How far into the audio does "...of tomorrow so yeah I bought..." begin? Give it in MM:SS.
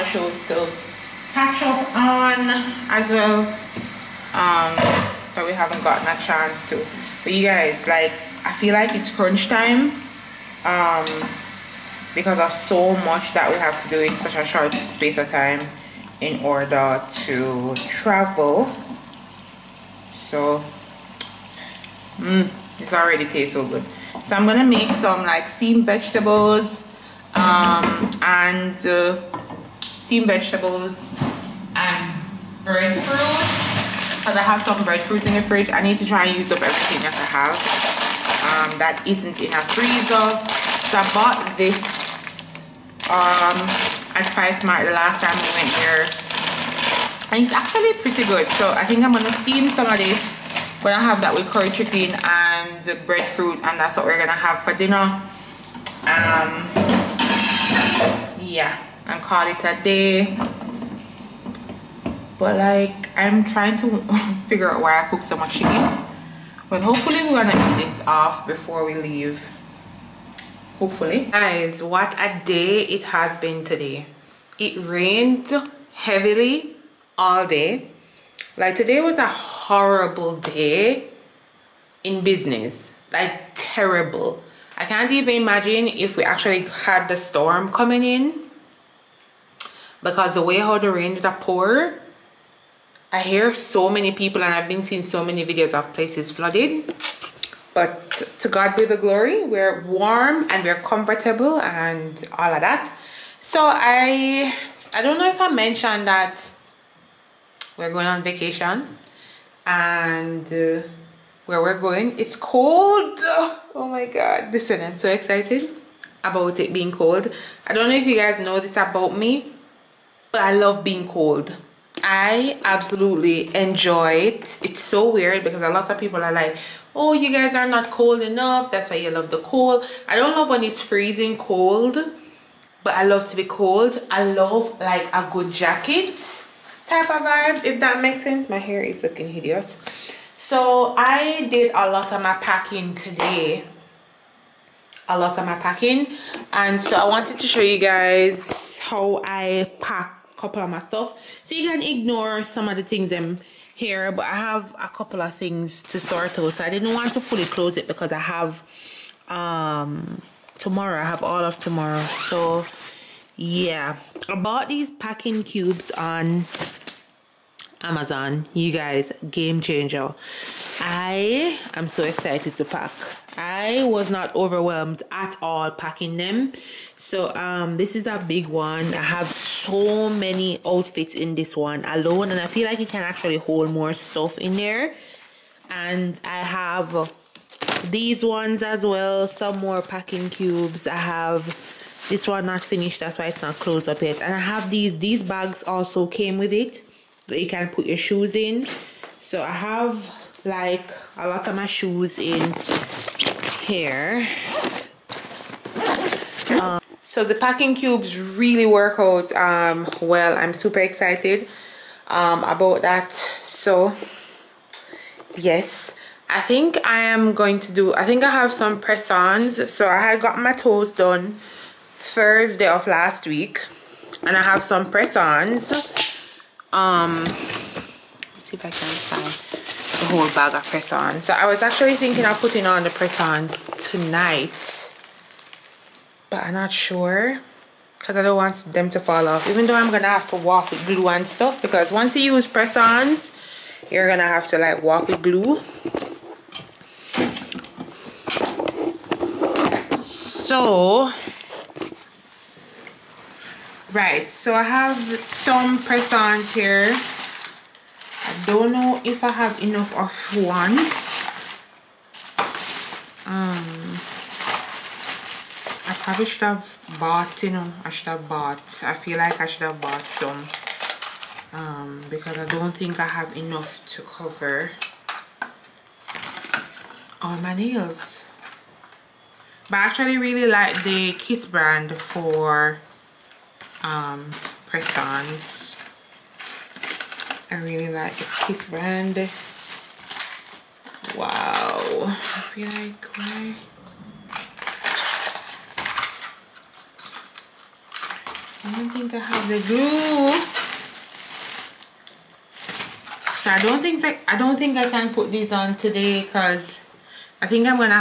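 02:41.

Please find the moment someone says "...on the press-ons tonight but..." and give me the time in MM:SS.
03:52.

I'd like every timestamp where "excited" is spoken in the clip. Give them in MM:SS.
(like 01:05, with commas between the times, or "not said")
01:55, 02:52, 03:30.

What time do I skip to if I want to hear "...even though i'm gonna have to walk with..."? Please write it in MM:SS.
03:59.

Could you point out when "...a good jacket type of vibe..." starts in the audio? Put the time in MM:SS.
02:15.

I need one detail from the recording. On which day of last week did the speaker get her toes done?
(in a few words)
Thursday.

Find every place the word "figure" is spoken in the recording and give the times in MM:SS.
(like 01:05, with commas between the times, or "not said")
01:04.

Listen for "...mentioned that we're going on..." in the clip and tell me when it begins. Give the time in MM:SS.
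01:45.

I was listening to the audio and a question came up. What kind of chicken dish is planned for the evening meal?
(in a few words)
curry chicken.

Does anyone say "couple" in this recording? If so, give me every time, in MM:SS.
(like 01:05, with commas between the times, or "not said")
02:30, 02:34.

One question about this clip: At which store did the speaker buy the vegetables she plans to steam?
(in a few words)
PriceSmart.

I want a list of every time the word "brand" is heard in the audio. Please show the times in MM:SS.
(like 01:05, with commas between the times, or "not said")
04:41, 04:48.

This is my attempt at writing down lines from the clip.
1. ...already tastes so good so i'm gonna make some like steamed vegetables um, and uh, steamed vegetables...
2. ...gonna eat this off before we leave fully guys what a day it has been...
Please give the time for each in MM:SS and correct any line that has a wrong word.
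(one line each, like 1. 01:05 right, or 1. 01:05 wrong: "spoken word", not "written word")
1. 00:22 right
2. 01:07 wrong: "hopefully", not "fully".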